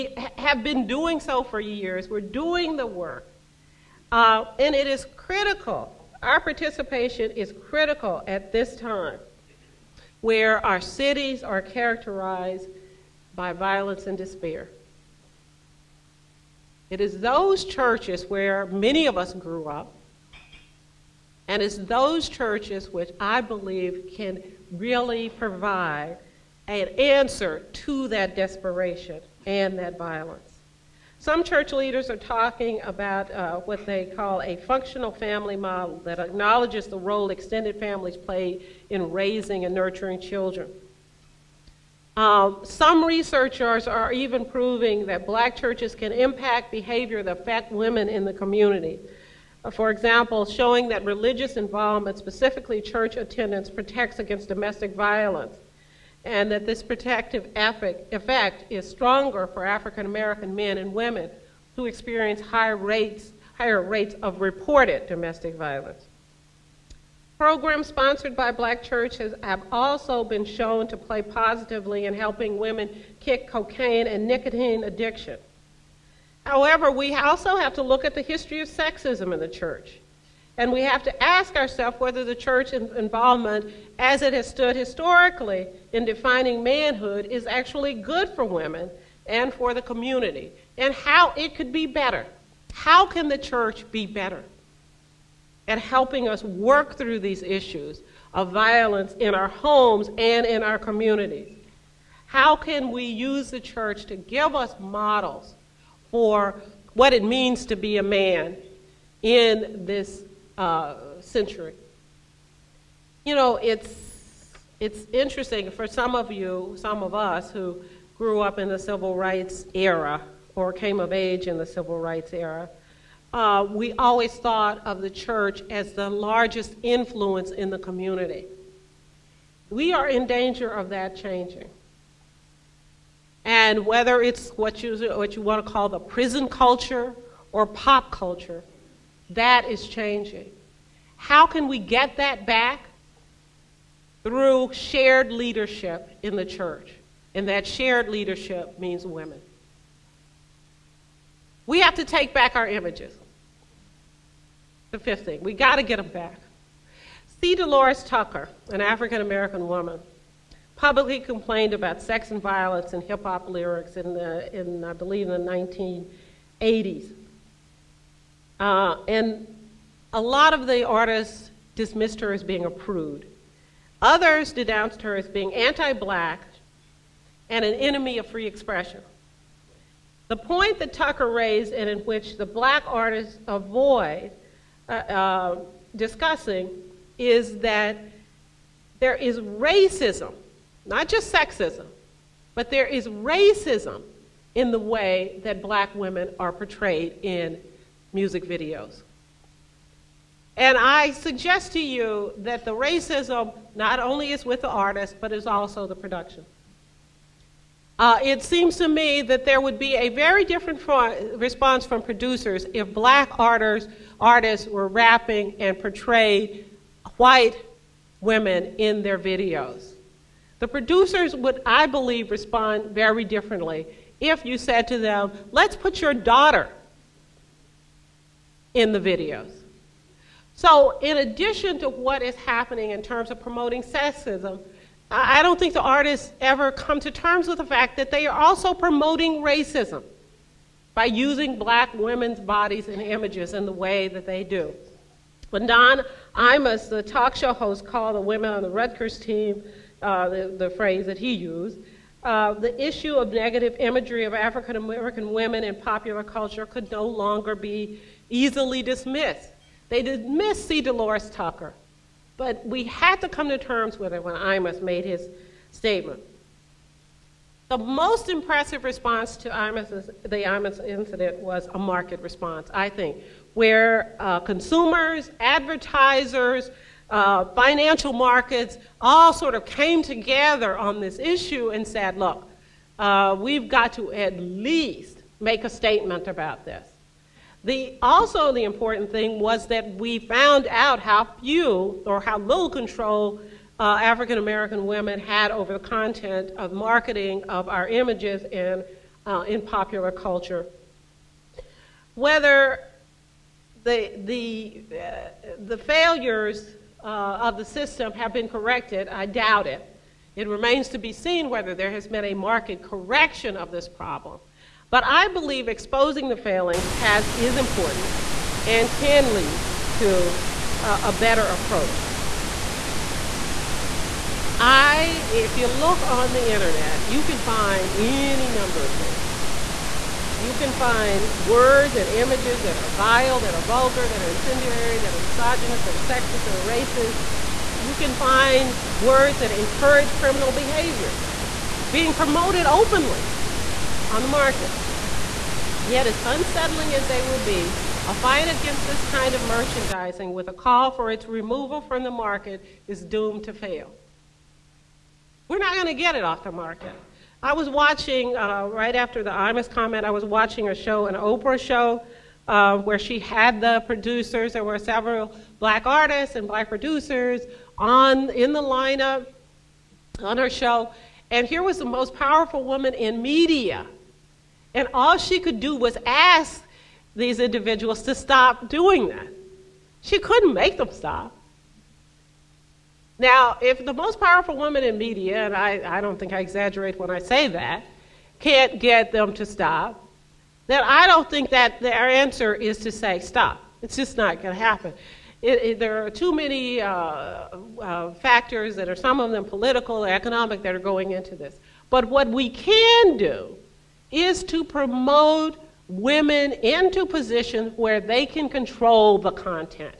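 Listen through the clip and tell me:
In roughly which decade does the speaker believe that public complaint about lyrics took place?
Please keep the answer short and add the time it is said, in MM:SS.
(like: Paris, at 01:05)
1980s, at 02:46.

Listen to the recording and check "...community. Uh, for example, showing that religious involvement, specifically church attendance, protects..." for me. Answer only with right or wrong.
right.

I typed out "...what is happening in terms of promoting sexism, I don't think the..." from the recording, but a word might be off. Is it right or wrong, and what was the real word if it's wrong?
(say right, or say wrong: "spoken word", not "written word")
right.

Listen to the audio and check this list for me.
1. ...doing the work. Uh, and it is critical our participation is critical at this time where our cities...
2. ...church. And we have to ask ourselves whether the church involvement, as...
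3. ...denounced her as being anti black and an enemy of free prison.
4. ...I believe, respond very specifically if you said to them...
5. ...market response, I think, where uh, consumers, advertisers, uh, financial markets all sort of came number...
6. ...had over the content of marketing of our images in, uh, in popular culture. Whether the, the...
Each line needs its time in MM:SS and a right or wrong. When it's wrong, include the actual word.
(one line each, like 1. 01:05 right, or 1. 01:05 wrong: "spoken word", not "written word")
1. 00:02 right
2. 01:19 right
3. 02:54 wrong: "expression", not "prison"
4. 03:41 wrong: "differently", not "specifically"
5. 04:31 wrong: "together", not "number"
6. 04:55 right.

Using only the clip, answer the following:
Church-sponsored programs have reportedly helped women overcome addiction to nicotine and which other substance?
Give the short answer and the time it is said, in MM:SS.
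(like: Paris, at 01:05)
cocaine, at 01:13.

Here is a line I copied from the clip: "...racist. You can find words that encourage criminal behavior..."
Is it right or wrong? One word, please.
right.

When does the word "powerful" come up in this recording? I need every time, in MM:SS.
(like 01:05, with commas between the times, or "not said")
06:12, 06:24.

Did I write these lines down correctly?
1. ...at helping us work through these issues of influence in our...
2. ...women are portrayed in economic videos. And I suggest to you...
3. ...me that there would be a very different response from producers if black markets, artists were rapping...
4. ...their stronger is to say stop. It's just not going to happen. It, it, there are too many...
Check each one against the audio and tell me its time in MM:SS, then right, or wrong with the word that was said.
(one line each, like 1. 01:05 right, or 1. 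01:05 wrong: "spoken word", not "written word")
1. 01:35 wrong: "violence", not "influence"
2. 03:15 wrong: "music", not "economic"
3. 03:28 wrong: "artists", not "markets"
4. 06:31 wrong: "answer", not "stronger".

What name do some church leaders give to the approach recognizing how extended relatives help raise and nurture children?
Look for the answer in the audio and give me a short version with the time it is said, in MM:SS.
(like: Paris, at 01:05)
functional family model, at 00:34.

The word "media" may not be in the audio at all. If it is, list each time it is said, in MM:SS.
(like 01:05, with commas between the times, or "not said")
06:13, 06:24.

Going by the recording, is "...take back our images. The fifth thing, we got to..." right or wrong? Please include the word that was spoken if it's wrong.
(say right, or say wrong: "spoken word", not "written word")
right.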